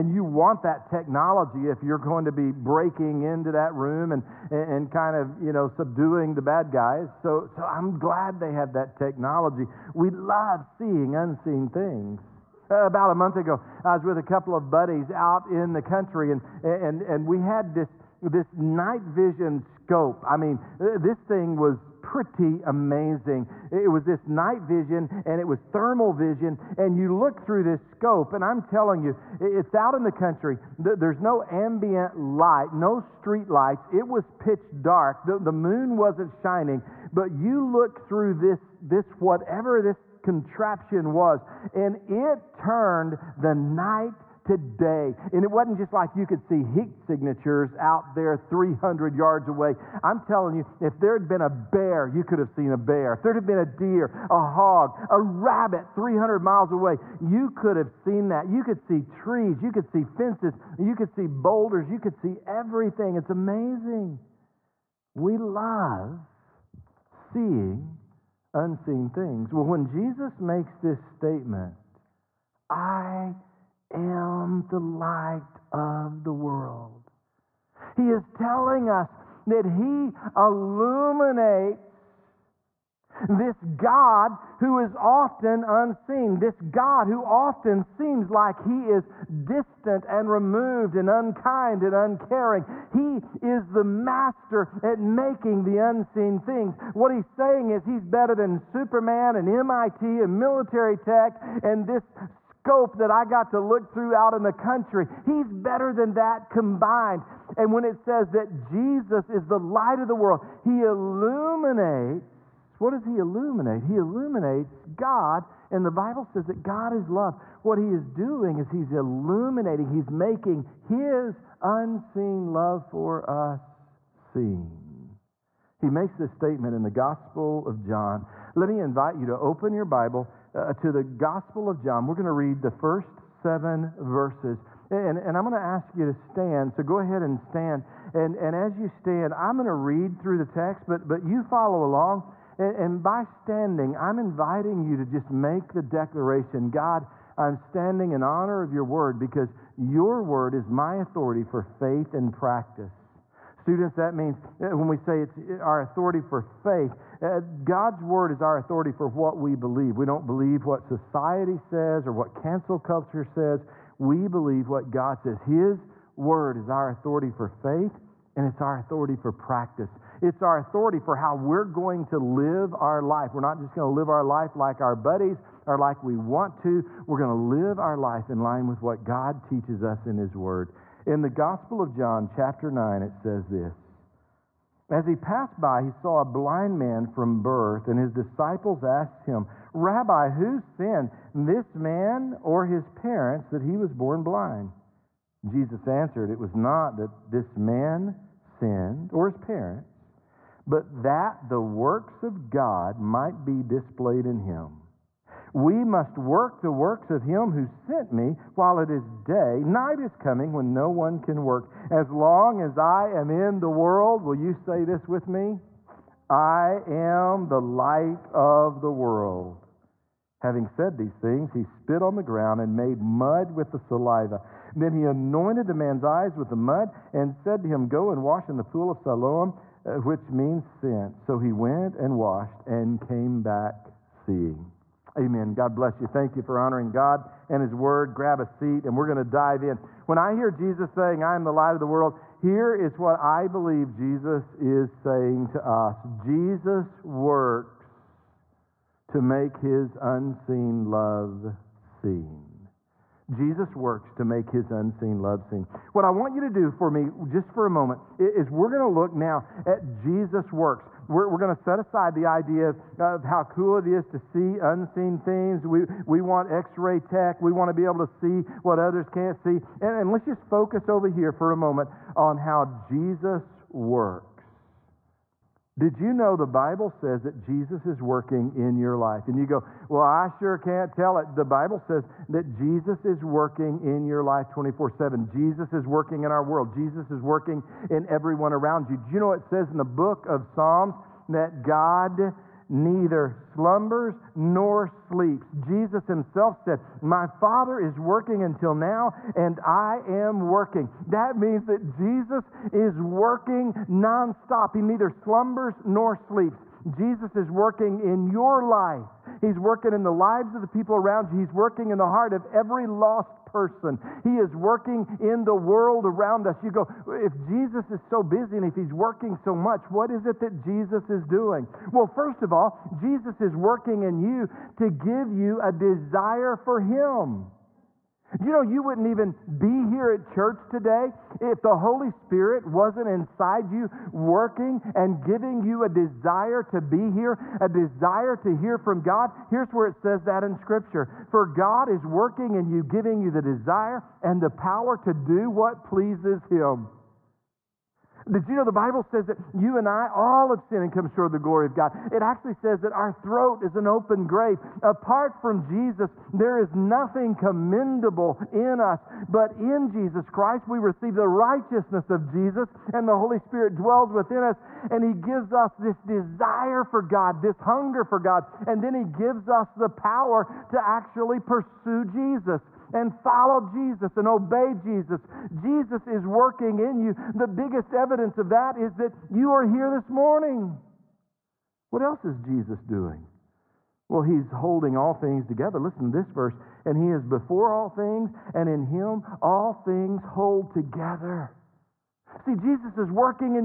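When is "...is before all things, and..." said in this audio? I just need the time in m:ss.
6:27.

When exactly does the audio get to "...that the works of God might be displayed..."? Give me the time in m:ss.
3:21.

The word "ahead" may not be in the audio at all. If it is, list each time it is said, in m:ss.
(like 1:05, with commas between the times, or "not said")
2:16.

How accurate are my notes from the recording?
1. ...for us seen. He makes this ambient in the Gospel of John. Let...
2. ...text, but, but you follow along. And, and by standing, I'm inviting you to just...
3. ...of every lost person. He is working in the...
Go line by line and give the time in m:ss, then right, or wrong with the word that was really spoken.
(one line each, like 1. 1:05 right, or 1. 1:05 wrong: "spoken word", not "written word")
1. 2:02 wrong: "statement", not "ambient"
2. 2:20 right
3. 5:12 right.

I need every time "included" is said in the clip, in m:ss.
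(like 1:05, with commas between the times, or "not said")
not said.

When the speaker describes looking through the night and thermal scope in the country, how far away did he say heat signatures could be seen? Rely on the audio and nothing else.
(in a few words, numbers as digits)
300 yards.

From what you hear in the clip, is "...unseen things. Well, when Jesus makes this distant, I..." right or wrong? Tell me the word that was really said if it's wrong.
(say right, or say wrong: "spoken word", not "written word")
wrong: "statement", not "distant".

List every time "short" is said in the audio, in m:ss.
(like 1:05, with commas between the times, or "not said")
5:51.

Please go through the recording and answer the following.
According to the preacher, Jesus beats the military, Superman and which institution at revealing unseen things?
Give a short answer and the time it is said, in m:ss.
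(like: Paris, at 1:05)
MIT, at 1:39.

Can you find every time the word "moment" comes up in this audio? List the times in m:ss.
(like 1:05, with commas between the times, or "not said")
4:17, 4:31.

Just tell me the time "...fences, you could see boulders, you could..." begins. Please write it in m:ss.
1:00.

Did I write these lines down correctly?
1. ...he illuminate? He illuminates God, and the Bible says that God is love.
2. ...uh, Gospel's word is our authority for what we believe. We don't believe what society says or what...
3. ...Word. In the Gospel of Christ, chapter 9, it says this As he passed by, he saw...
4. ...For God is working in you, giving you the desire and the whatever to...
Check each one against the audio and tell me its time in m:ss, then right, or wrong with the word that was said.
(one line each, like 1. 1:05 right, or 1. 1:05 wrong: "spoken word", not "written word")
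1. 1:53 right
2. 2:37 wrong: "God", not "Gospel"
3. 3:00 wrong: "John", not "Christ"
4. 5:41 wrong: "power", not "whatever".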